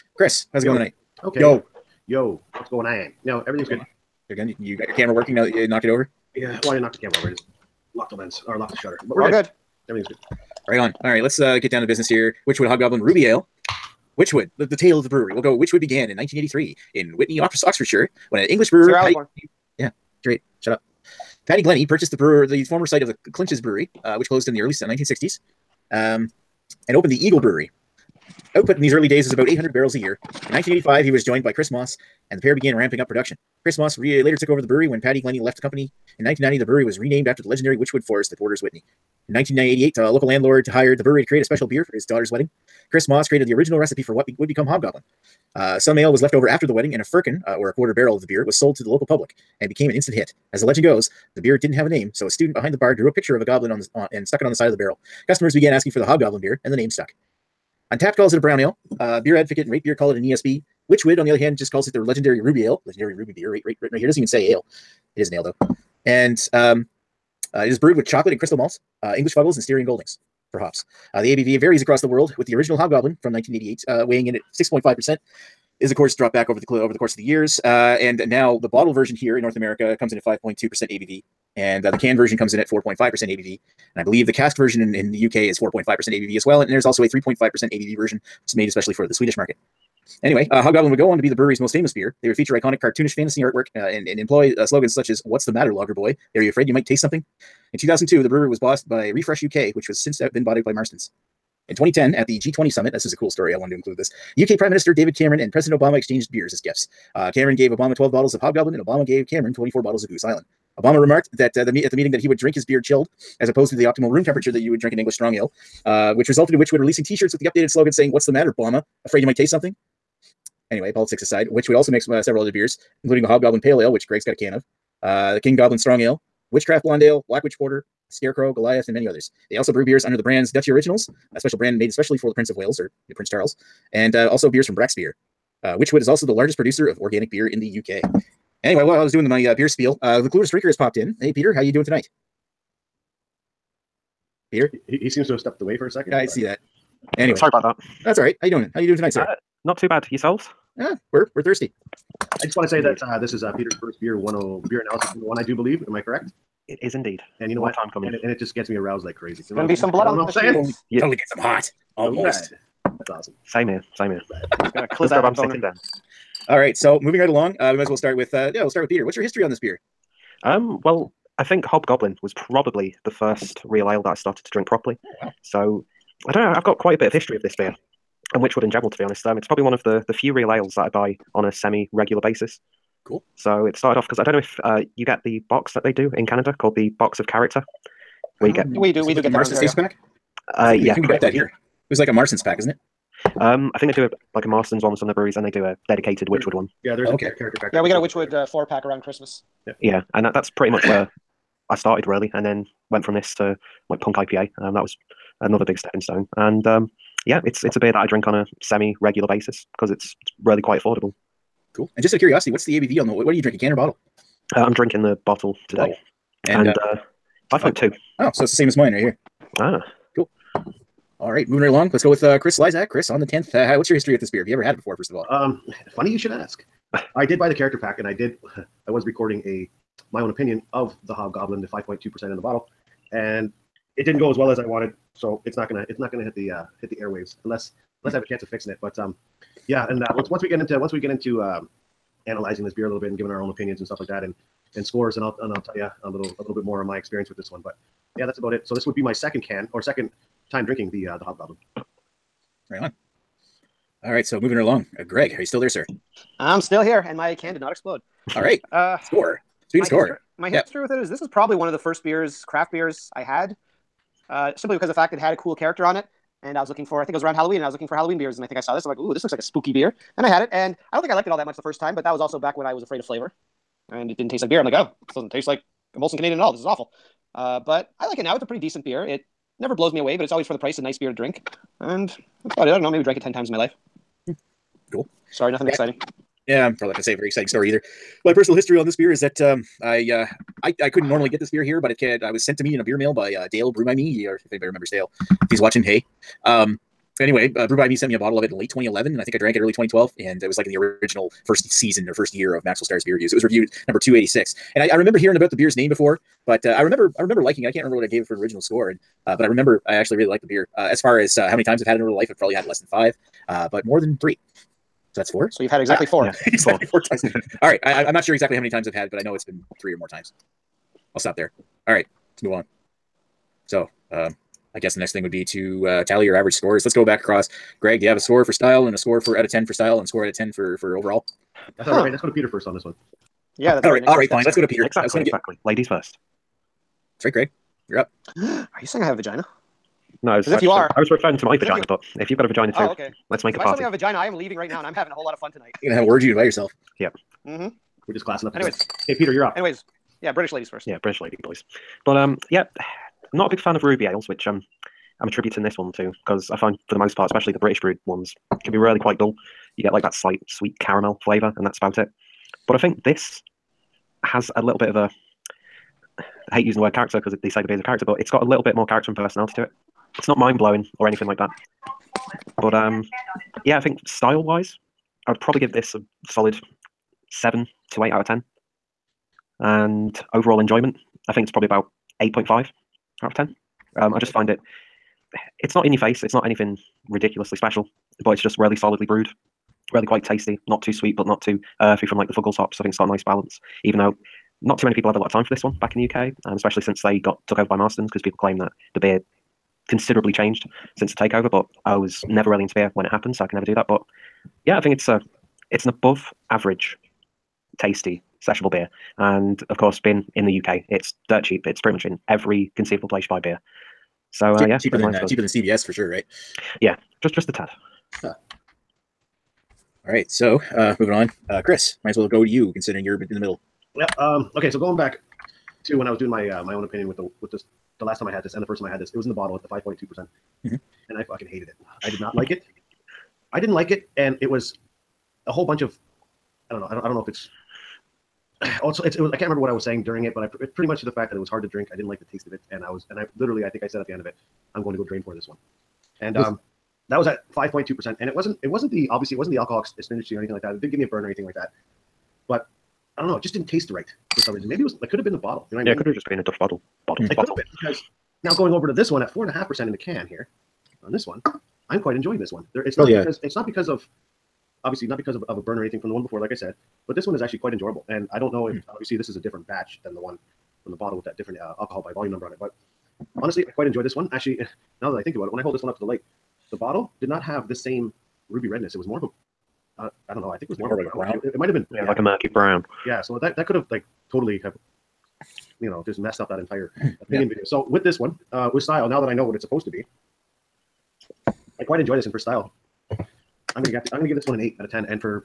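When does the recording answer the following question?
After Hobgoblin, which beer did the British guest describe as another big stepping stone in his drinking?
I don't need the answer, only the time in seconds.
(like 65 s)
204 s.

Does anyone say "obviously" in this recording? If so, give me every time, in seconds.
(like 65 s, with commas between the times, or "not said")
449 s, 464 s, 468 s.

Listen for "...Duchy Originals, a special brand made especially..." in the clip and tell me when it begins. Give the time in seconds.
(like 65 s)
130 s.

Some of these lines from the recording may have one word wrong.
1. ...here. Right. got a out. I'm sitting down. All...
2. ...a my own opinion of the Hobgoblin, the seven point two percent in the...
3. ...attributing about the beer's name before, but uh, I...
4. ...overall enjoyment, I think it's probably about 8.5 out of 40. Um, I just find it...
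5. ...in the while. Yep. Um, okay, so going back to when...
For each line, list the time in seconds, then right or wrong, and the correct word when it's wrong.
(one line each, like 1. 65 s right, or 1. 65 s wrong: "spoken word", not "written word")
1. 164 s right
2. 229 s wrong: "five", not "seven"
3. 305 s wrong: "hearing", not "attributing"
4. 380 s wrong: "10", not "40"
5. 423 s wrong: "middle", not "while".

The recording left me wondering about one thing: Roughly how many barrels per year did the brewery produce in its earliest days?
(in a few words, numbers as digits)
800.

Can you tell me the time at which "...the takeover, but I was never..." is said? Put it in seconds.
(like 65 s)
401 s.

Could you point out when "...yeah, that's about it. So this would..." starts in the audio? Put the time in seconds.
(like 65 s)
248 s.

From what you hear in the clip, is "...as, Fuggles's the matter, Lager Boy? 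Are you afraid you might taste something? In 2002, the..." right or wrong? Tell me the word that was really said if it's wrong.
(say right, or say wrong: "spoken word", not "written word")
wrong: "What", not "Fuggles".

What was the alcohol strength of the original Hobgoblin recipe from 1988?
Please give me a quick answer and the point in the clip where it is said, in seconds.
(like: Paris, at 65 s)
6.5%, at 74 s.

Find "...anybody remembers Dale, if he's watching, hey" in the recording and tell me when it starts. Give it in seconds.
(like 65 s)
294 s.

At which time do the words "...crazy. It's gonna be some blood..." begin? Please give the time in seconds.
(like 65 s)
159 s.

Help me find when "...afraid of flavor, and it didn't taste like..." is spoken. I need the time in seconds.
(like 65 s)
272 s.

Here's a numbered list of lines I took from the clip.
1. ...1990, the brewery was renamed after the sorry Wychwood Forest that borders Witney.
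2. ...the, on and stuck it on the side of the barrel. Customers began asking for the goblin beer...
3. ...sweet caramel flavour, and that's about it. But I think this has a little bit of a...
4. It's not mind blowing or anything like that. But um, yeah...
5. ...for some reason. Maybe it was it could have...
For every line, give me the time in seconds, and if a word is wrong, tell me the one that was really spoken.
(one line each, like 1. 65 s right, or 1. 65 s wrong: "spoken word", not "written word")
1. 36 s wrong: "legendary", not "sorry"
2. 53 s wrong: "hobgoblin", not "goblin"
3. 360 s right
4. 370 s right
5. 454 s right.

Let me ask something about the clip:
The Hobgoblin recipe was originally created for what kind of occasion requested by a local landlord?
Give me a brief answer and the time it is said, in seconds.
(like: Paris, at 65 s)
His daughter's wedding, at 42 s.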